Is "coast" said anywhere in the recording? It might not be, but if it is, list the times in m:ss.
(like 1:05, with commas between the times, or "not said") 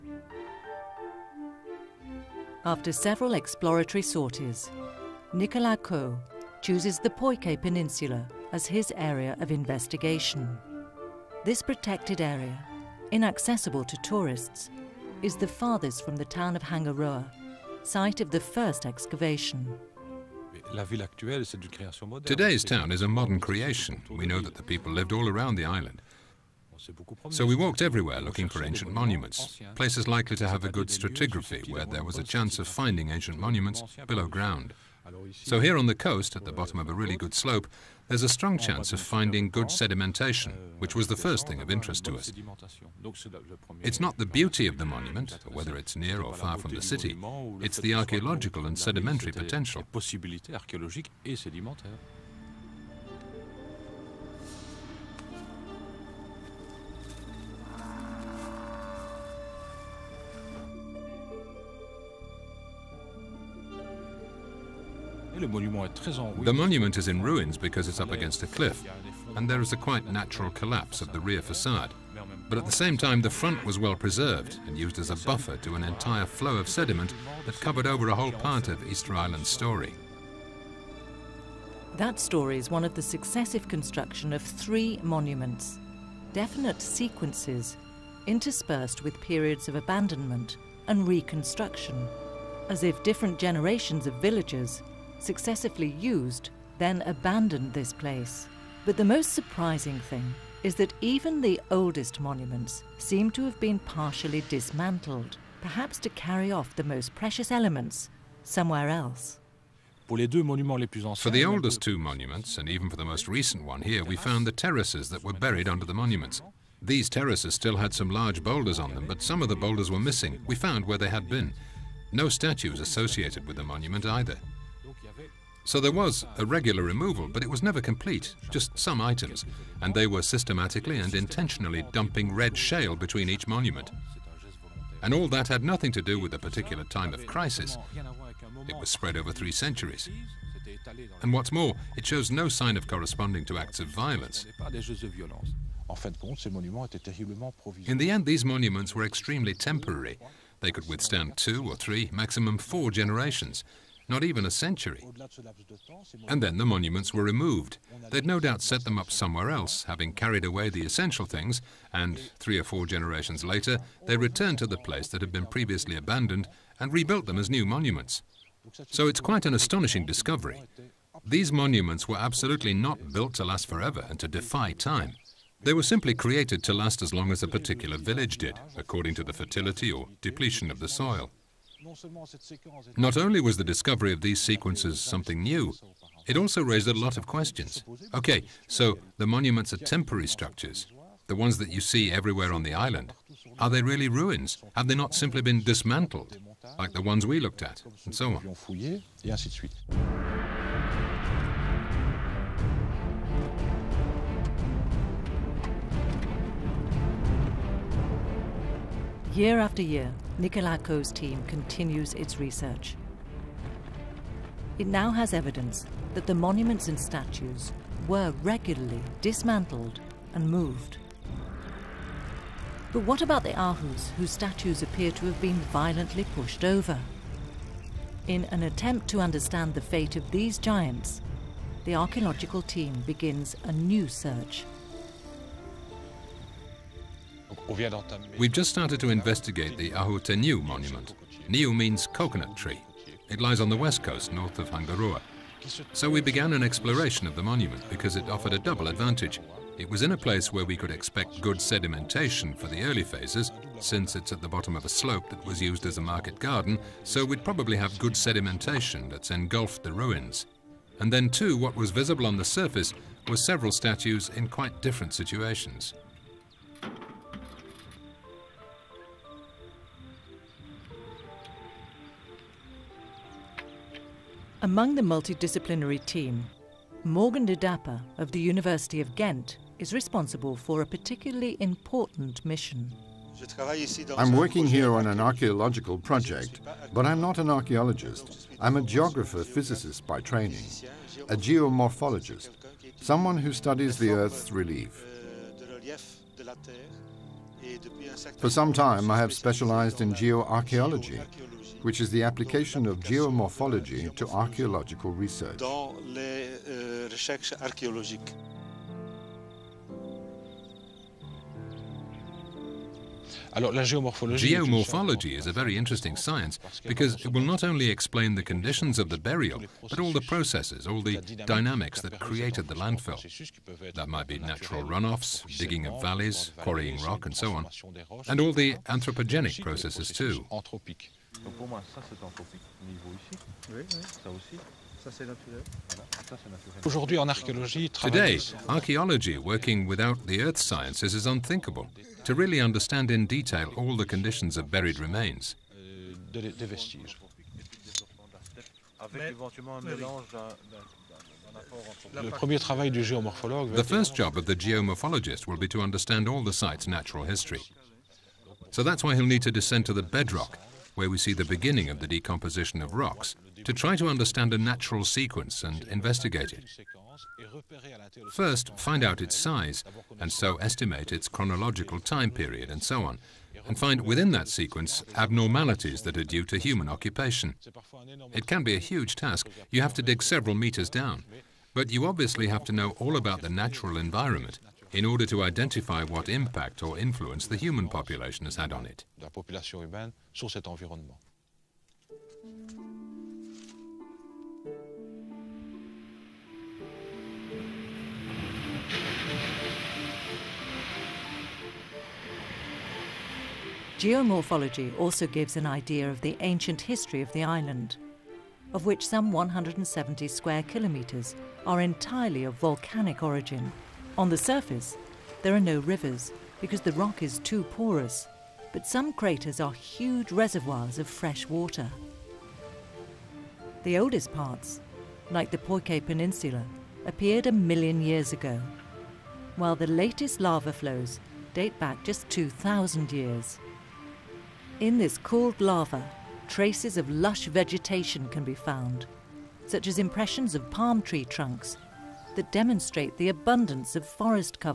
0:35, 4:04.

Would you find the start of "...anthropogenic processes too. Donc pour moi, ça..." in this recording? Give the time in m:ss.
5:28.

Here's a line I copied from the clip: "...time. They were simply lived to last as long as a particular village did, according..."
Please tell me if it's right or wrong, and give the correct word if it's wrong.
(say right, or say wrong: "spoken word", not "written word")
wrong: "created", not "lived".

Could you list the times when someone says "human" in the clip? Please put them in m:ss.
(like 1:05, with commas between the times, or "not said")
6:16, 6:27.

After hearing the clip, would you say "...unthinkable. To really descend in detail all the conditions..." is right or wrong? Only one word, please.
wrong.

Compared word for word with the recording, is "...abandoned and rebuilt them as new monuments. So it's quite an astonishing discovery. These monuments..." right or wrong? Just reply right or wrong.
right.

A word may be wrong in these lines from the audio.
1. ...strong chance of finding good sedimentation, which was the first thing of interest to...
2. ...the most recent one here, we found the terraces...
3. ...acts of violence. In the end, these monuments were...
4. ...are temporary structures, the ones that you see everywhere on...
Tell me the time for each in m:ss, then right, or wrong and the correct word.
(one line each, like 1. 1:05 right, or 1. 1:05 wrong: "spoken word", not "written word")
1. 0:38 right
2. 1:52 right
3. 2:23 right
4. 3:09 right.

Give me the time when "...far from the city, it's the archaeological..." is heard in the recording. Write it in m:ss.
0:46.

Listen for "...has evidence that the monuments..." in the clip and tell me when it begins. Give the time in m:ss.
3:35.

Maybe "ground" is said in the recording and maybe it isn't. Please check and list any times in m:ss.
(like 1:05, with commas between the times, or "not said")
0:34.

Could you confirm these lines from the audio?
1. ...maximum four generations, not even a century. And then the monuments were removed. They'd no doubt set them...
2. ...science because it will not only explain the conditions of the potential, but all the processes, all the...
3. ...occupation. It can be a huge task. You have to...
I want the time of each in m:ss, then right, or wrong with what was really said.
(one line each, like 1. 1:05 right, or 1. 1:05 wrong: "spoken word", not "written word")
1. 2:32 right
2. 5:16 wrong: "burial", not "potential"
3. 6:16 right.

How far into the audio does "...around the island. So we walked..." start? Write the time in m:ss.
0:25.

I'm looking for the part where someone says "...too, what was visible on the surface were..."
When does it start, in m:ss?
4:21.